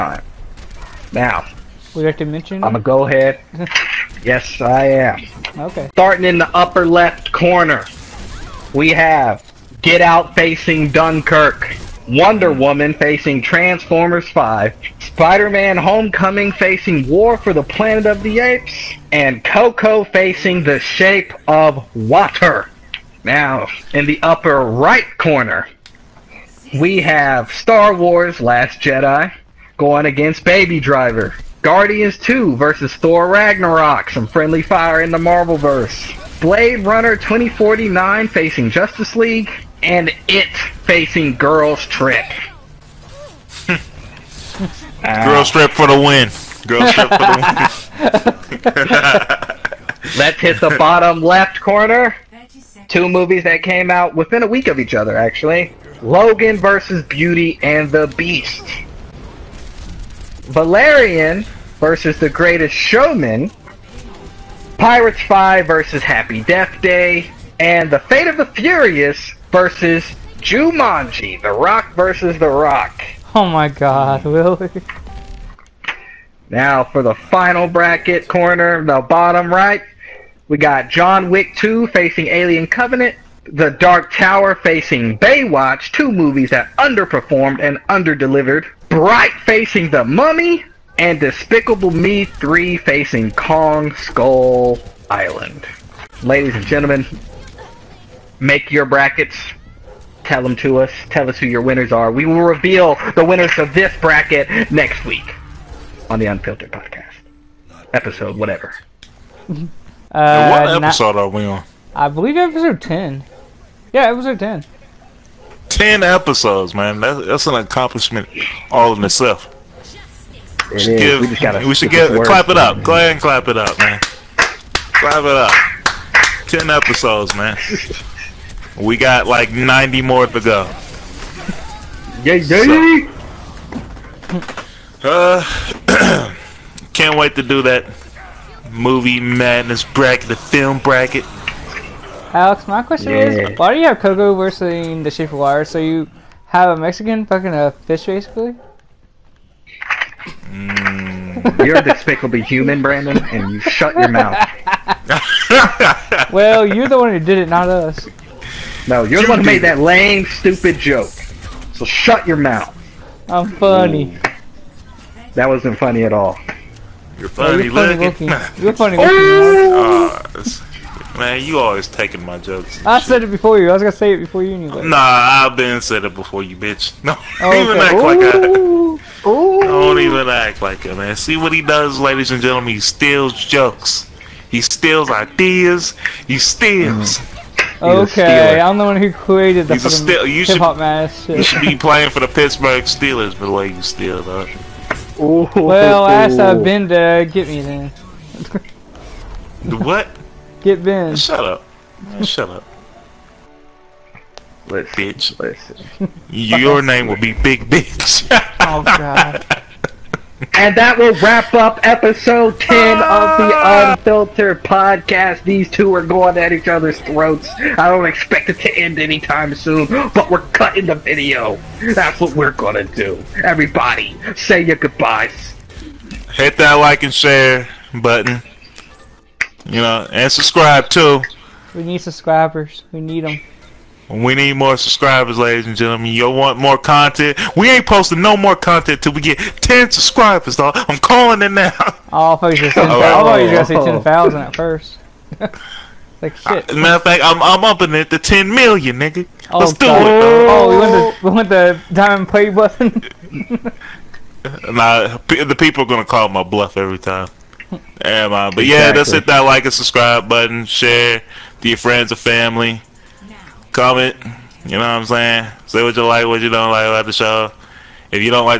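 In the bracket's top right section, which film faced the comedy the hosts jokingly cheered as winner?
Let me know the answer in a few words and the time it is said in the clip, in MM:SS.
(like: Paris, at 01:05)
Blade Runner 2049, at 00:36.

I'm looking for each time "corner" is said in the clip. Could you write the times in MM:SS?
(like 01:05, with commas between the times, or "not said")
00:07, 00:25, 00:51, 01:18.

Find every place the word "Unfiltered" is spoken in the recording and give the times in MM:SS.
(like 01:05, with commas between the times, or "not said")
01:46, 03:33.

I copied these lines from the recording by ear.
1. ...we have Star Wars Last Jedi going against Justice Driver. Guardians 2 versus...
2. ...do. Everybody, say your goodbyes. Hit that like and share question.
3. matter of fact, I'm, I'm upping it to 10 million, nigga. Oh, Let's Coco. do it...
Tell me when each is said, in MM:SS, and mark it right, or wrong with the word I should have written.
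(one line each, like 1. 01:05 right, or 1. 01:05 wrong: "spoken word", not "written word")
1. 00:26 wrong: "Baby", not "Justice"
2. 03:42 wrong: "button", not "question"
3. 04:06 wrong: "God", not "Coco".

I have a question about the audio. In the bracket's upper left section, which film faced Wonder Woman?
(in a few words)
Transformers 5.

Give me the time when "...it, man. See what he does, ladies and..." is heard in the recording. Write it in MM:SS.
03:00.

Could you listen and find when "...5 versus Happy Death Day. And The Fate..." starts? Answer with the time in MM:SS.
01:05.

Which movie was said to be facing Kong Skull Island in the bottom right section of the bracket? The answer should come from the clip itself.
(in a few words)
Despicable Me 3.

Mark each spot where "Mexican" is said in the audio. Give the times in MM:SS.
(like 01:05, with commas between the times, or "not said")
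02:26.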